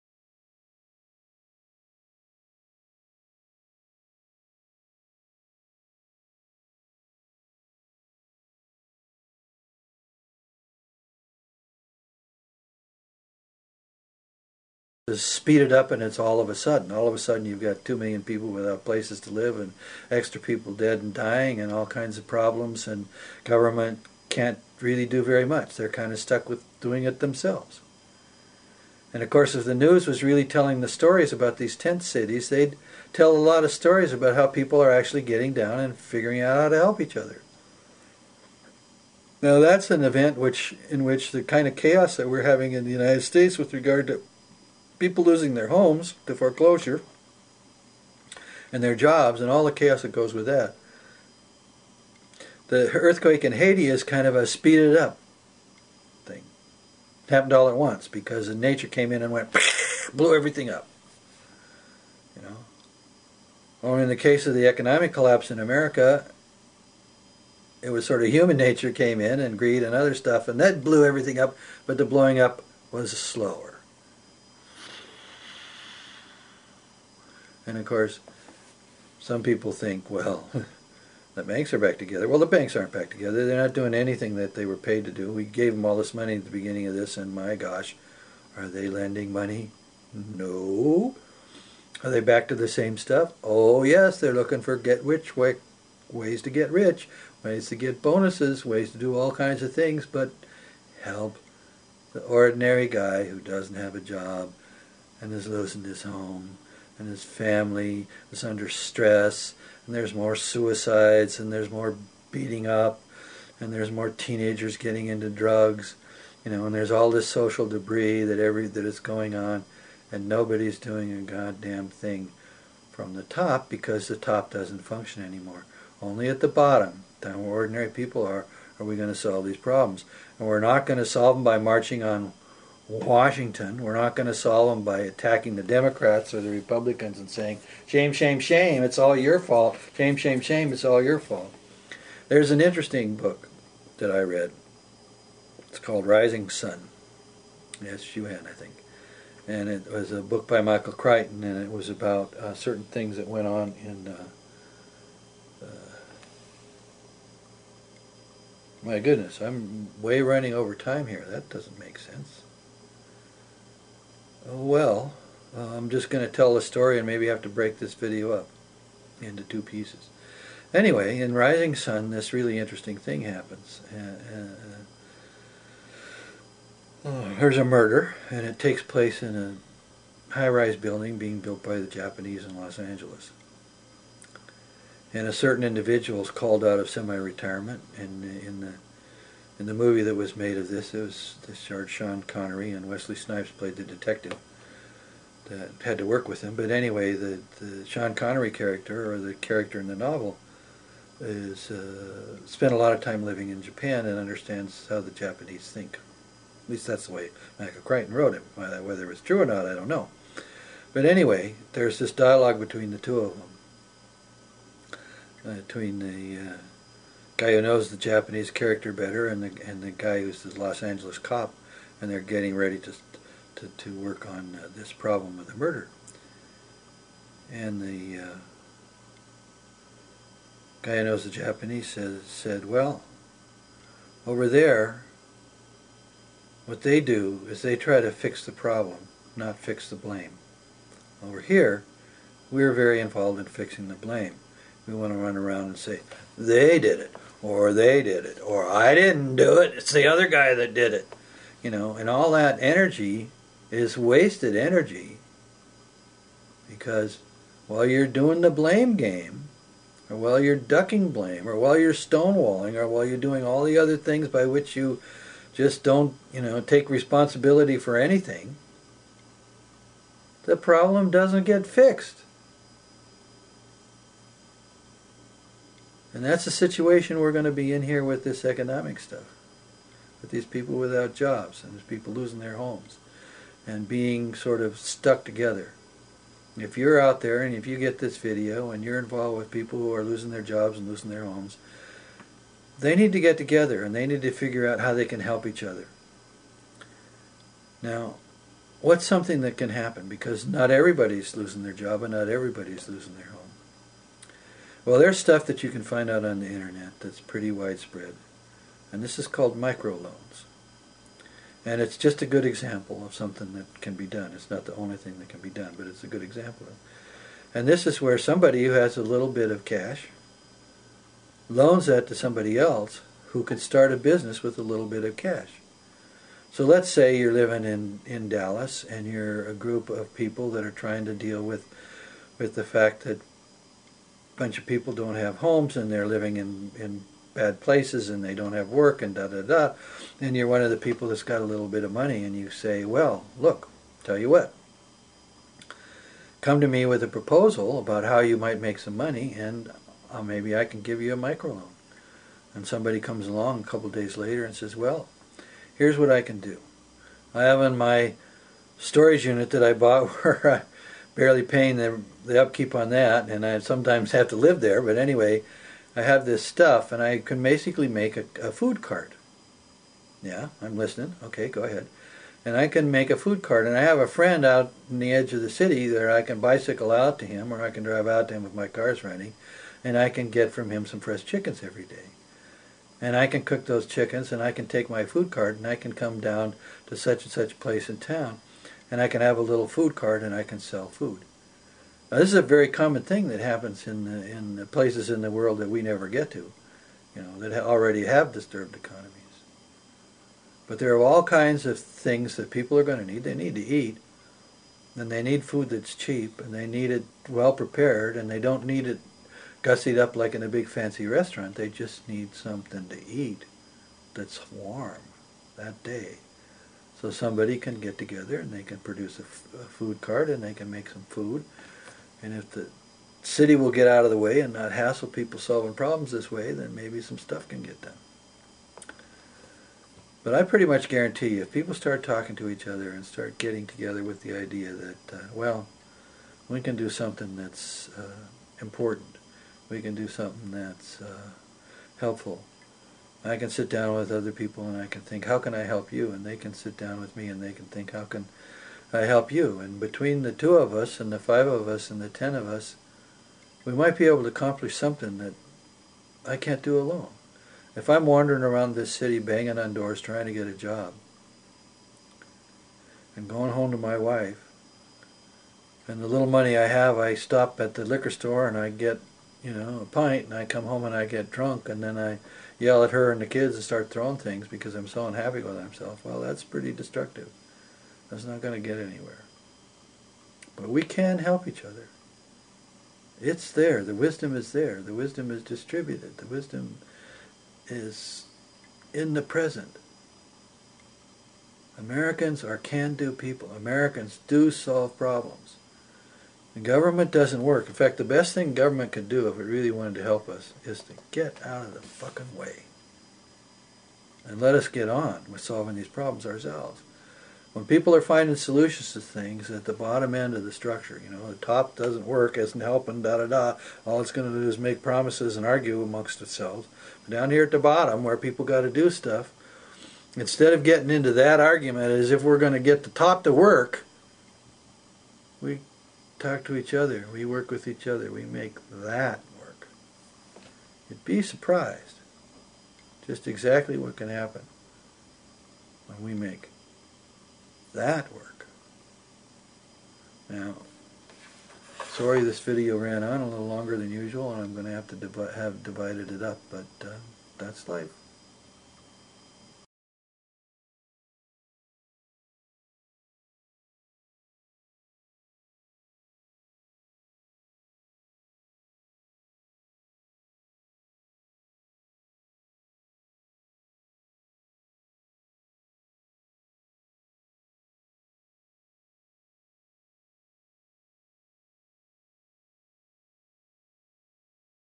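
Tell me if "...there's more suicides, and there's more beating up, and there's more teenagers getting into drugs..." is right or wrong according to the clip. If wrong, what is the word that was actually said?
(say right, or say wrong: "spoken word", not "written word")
right.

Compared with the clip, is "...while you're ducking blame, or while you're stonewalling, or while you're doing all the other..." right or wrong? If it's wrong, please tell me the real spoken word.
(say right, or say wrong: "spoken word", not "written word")
right.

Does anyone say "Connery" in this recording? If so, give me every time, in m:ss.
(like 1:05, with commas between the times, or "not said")
3:12, 3:18.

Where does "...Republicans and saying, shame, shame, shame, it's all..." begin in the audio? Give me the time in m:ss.
2:16.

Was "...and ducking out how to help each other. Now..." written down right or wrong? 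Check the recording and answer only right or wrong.
wrong.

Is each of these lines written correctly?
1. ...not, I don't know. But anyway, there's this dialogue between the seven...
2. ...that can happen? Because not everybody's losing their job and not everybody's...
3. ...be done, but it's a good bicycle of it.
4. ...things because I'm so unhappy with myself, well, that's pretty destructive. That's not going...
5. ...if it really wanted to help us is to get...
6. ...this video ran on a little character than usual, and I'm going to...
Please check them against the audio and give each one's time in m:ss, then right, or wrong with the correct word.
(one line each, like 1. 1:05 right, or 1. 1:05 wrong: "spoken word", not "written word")
1. 3:29 wrong: "two", not "seven"
2. 4:59 right
3. 5:15 wrong: "example", not "bicycle"
4. 7:54 right
5. 8:19 right
6. 9:02 wrong: "longer", not "character".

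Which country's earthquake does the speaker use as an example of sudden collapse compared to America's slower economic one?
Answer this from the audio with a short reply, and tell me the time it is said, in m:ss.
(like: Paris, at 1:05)
Haiti, at 0:53.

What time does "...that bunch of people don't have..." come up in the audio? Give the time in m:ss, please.
5:33.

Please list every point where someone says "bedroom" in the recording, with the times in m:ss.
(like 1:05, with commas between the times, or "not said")
not said.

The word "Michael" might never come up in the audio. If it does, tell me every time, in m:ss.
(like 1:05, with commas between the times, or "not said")
2:30, 3:27.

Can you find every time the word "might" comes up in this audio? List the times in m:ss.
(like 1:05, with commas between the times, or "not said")
5:48, 7:33.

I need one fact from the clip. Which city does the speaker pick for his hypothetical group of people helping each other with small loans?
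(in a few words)
Dallas.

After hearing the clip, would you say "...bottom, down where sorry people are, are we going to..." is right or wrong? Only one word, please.
wrong.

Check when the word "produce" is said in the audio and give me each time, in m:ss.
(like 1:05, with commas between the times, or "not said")
6:58.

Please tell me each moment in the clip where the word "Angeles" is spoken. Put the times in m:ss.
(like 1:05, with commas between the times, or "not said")
3:02, 3:40.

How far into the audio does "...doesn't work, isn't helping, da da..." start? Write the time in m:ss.
8:31.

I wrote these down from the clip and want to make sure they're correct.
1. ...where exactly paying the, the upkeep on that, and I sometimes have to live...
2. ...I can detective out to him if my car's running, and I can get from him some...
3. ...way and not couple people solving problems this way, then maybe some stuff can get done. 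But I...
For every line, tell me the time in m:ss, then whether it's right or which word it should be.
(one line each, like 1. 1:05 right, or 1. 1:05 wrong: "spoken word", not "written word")
1. 6:00 wrong: "barely", not "exactly"
2. 6:17 wrong: "drive", not "detective"
3. 7:04 wrong: "hassle", not "couple".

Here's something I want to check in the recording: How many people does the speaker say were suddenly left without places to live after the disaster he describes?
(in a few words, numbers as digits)
2 million.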